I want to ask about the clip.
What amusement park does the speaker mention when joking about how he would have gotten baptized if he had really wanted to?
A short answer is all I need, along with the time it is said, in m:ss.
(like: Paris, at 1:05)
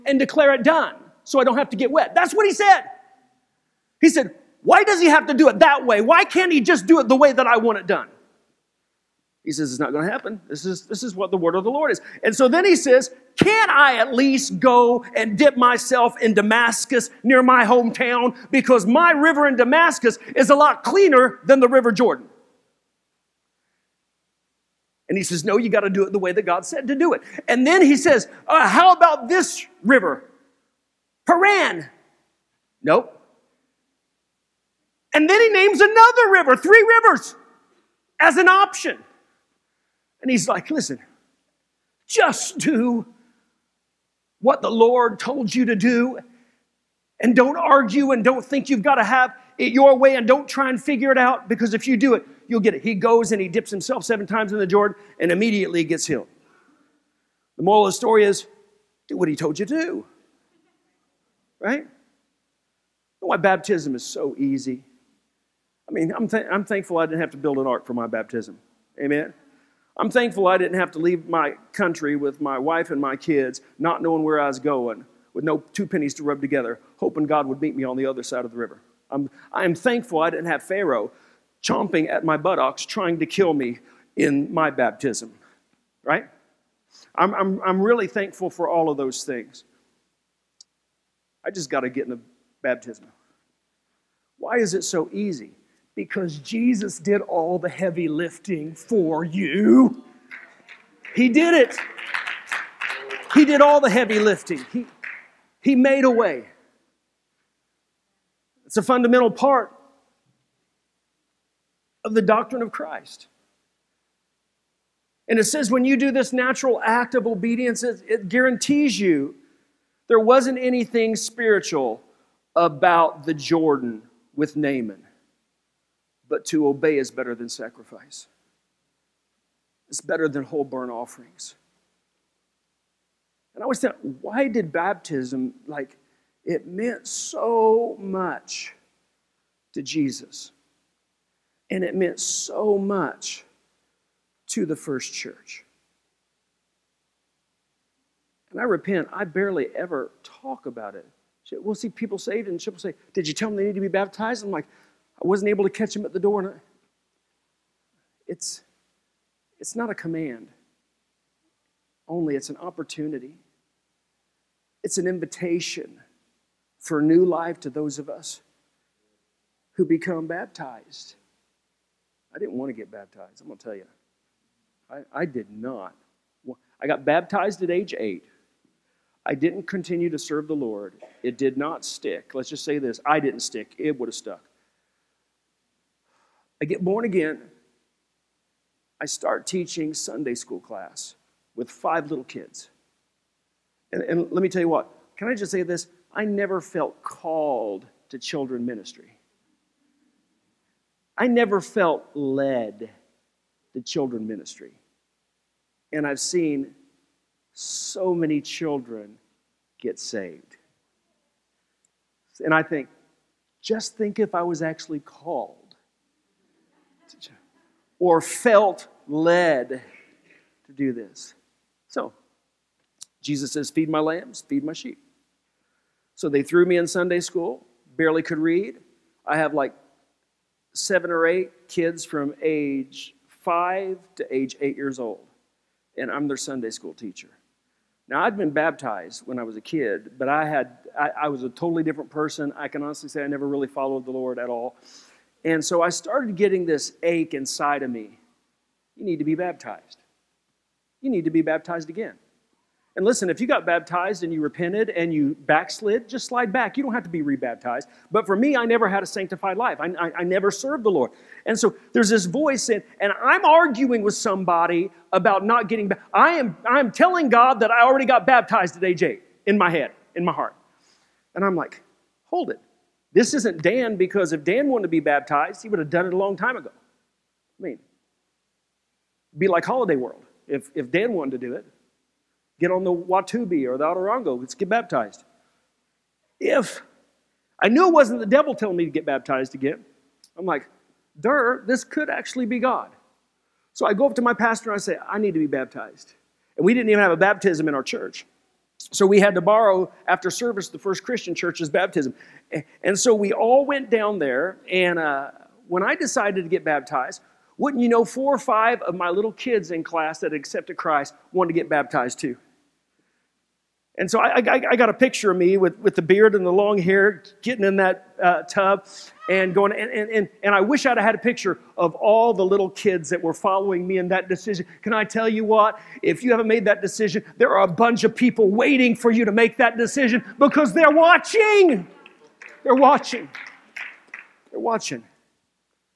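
Holiday World, at 4:39.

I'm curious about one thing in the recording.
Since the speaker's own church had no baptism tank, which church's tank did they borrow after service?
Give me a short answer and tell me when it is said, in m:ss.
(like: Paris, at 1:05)
First Christian church, at 5:00.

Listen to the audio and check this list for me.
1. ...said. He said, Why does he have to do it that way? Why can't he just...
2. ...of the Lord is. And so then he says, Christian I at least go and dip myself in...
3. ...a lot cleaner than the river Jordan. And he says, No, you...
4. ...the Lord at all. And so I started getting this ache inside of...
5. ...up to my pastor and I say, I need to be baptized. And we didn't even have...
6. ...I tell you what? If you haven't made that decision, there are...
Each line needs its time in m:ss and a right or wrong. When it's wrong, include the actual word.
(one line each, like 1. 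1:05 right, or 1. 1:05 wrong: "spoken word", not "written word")
1. 0:02 right
2. 0:11 wrong: "Can", not "Christian"
3. 0:20 right
4. 4:04 right
5. 4:54 right
6. 5:24 right.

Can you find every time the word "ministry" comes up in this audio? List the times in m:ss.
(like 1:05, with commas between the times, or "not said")
3:18, 3:24.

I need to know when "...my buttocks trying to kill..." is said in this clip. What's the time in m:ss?
1:22.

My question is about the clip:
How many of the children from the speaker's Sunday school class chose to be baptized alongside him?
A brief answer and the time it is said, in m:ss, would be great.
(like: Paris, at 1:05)
4 or 5, at 5:08.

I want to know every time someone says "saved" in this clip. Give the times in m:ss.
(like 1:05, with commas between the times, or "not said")
2:32, 3:29.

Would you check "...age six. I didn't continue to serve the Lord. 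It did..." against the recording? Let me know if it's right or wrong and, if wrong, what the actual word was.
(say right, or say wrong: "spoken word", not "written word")
wrong: "eight", not "six".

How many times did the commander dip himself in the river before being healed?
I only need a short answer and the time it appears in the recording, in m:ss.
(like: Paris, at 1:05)
7, at 0:54.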